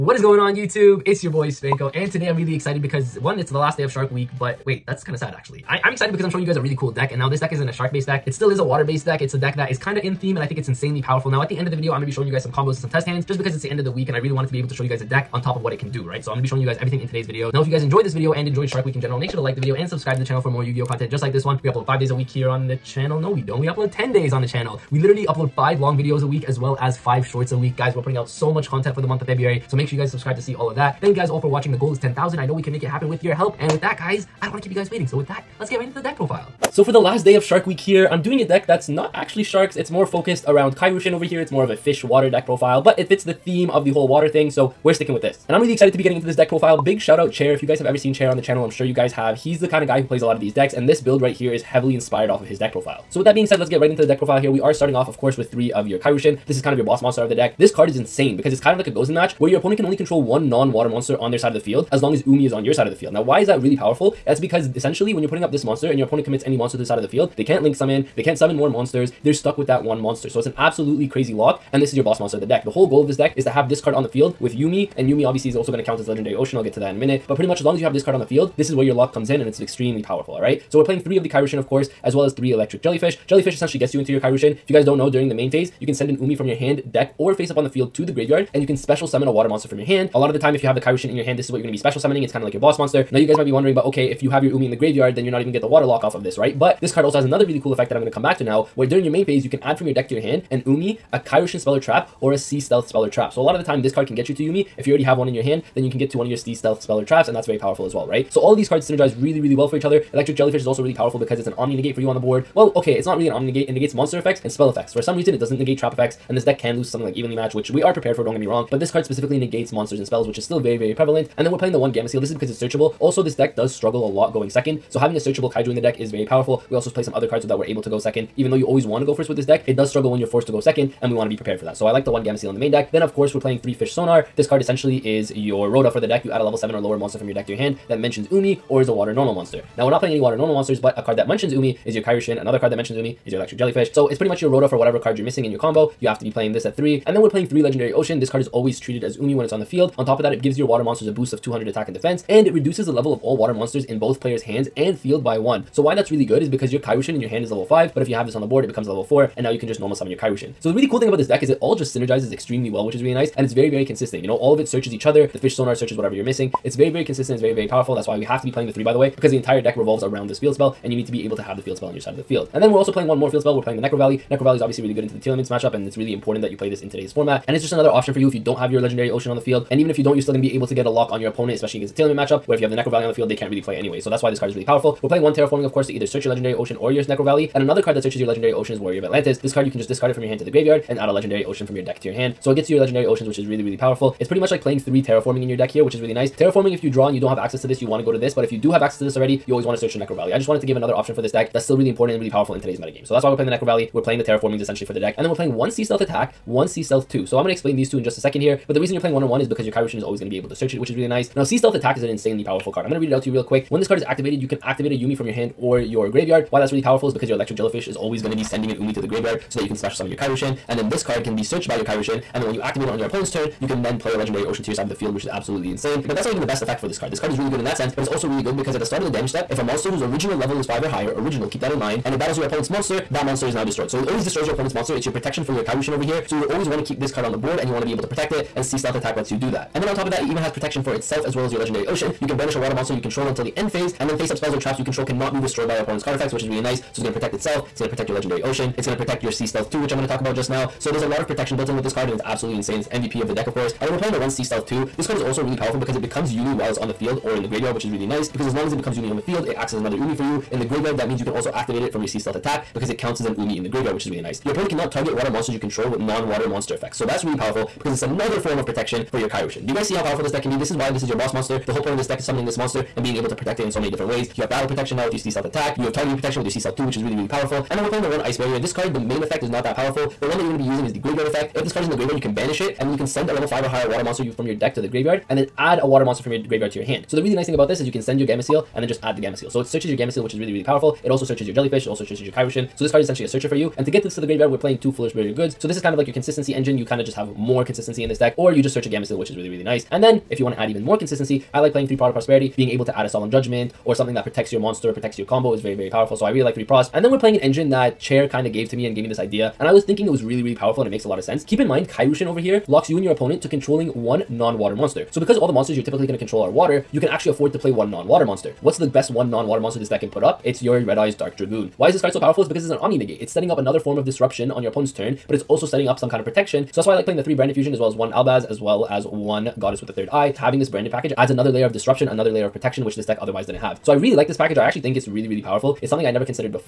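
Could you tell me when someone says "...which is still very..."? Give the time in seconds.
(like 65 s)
120 s.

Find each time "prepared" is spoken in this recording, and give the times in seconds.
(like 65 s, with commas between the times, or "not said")
117 s, 131 s.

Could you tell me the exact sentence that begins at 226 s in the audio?
But that's not even the best effect for this card.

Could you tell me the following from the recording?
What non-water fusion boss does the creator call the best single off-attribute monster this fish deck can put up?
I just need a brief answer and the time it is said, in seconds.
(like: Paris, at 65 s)
Red Eyes Dark Dragoon, at 320 s.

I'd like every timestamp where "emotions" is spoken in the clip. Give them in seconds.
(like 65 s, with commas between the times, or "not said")
not said.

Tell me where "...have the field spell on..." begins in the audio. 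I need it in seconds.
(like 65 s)
171 s.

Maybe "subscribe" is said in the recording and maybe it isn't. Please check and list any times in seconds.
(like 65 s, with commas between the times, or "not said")
19 s, 30 s.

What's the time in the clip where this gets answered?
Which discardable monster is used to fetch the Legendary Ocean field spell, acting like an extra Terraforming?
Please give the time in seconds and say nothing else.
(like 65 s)
188 s.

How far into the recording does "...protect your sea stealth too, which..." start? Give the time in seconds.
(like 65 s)
248 s.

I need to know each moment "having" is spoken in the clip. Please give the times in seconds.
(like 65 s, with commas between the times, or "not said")
124 s, 330 s.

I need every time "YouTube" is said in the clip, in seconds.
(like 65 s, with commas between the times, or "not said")
0 s.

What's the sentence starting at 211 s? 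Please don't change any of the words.
Now, Sea Stealth attack is an insanely powerful card.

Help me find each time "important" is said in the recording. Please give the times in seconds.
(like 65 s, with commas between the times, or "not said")
176 s, 201 s.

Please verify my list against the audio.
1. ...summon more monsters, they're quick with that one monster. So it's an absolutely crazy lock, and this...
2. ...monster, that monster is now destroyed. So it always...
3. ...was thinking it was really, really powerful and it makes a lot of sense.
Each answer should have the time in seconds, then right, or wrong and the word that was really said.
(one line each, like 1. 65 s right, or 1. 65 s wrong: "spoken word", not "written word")
1. 68 s wrong: "stuck", not "quick"
2. 232 s right
3. 309 s right.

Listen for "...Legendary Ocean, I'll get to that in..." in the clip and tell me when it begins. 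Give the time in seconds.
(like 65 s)
76 s.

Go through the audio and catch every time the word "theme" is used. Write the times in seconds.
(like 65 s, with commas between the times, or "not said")
10 s, 43 s.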